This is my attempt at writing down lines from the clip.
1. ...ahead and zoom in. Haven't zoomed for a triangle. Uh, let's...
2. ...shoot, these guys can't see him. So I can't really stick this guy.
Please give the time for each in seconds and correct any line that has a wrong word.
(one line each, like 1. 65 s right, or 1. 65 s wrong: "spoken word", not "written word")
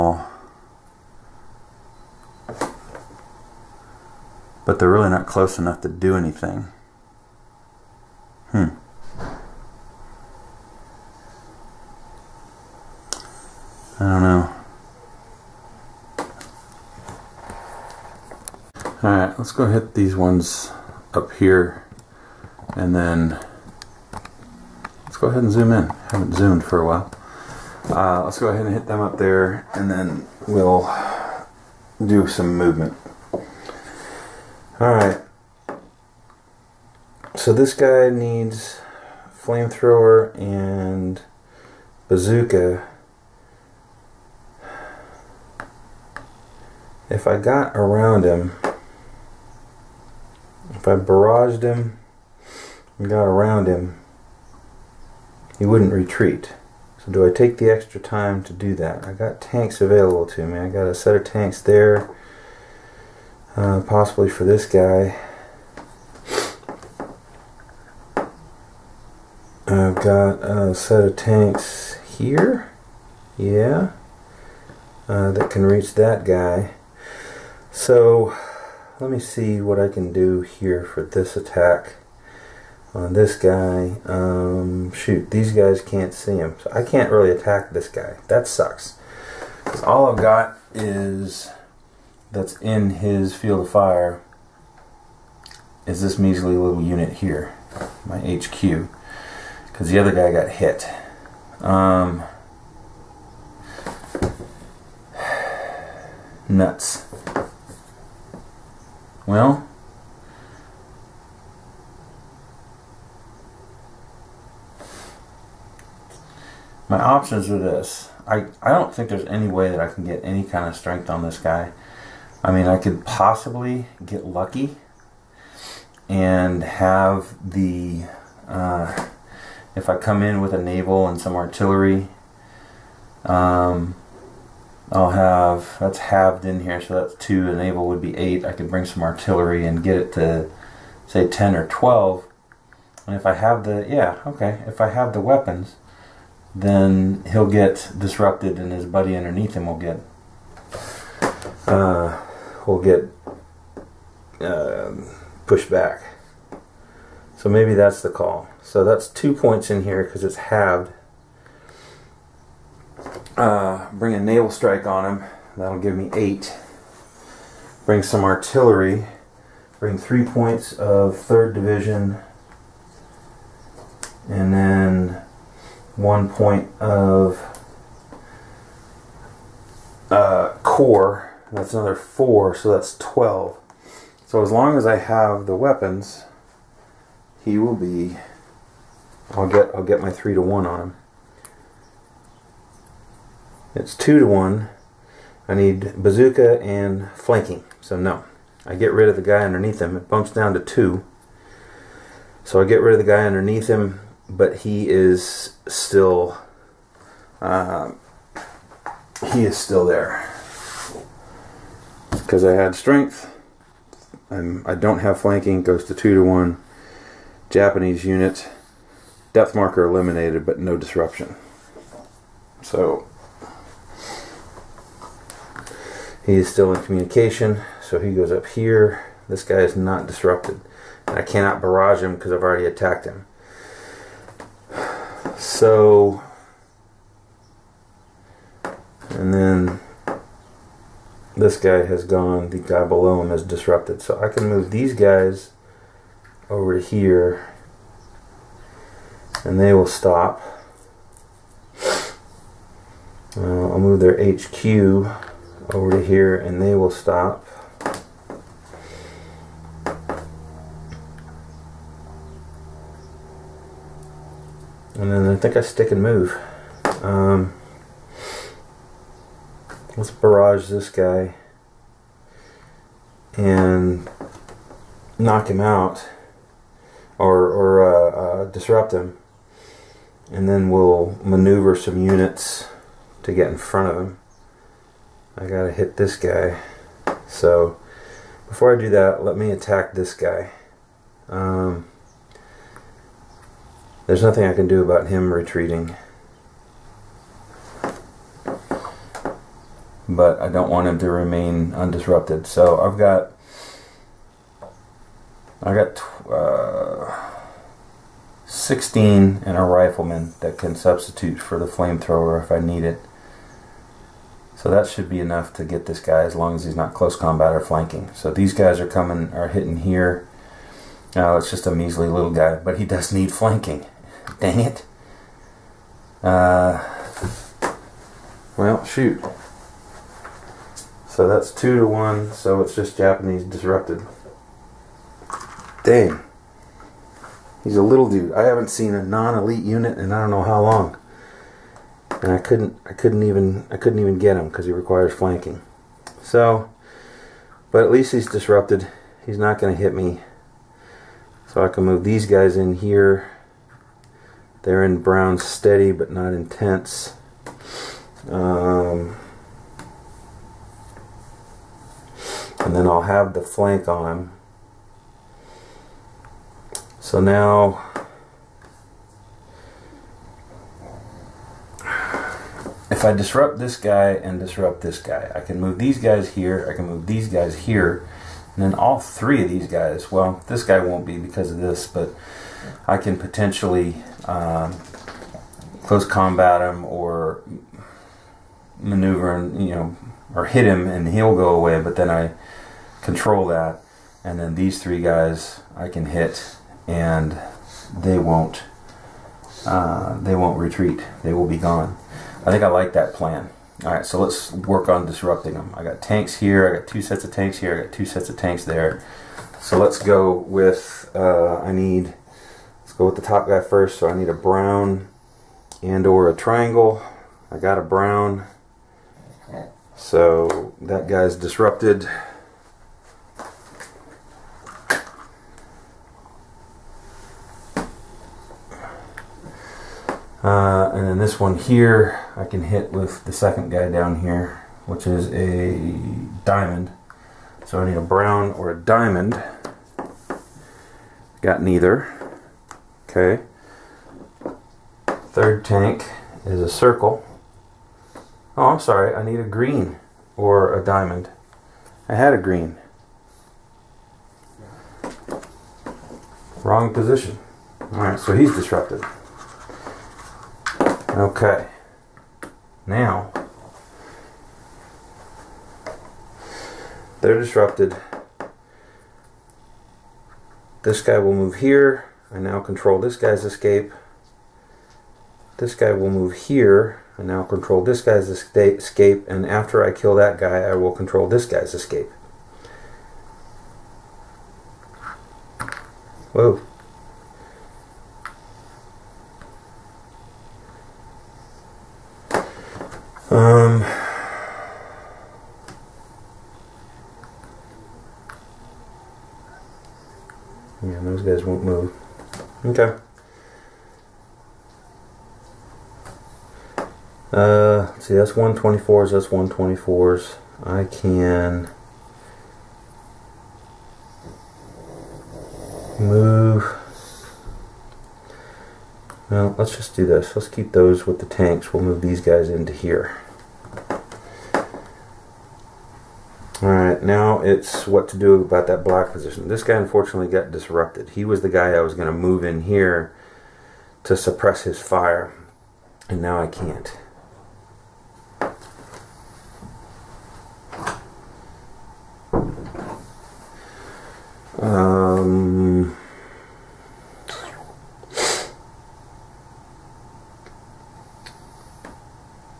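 1. 25 s wrong: "while", not "triangle"
2. 84 s wrong: "attack", not "stick".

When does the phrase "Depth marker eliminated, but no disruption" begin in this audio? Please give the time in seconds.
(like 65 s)
219 s.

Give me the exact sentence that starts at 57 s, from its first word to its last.
So do I take the extra time to do that?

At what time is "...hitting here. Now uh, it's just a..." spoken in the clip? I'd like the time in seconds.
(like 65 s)
319 s.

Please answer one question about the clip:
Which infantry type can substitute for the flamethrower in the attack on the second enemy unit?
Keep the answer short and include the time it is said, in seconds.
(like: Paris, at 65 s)
rifleman, at 309 s.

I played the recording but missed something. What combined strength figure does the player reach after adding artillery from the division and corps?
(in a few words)
12.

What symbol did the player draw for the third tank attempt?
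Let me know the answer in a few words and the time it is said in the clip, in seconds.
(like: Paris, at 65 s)
circle, at 446 s.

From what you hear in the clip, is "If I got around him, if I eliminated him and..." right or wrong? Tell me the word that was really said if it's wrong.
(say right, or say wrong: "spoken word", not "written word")
wrong: "barraged", not "eliminated".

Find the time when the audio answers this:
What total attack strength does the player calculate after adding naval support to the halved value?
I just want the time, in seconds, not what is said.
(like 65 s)
165 s.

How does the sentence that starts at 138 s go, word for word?
I could bring some artillery and get it to, say, 10 or 12.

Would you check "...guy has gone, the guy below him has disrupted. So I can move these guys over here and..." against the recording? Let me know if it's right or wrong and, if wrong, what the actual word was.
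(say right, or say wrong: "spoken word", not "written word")
right.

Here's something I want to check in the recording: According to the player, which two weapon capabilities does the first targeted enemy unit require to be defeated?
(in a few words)
flamethrower and bazooka.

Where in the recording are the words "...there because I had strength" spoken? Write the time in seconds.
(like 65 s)
209 s.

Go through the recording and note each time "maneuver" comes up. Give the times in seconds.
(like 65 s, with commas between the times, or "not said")
281 s, 388 s.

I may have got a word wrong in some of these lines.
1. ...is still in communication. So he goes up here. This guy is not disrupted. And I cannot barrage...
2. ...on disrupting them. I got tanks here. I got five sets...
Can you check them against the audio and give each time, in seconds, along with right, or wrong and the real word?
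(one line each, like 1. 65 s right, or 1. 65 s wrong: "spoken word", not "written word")
1. 226 s right
2. 404 s wrong: "two", not "five".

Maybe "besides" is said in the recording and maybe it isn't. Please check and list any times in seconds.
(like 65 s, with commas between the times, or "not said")
not said.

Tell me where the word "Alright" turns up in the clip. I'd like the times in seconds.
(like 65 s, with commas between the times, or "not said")
19 s, 34 s.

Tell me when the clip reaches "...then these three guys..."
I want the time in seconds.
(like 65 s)
394 s.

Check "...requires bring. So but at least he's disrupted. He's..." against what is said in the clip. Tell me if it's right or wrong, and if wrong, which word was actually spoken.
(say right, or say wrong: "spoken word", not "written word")
wrong: "flanking", not "bring".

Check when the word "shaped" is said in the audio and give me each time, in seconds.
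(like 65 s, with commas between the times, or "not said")
not said.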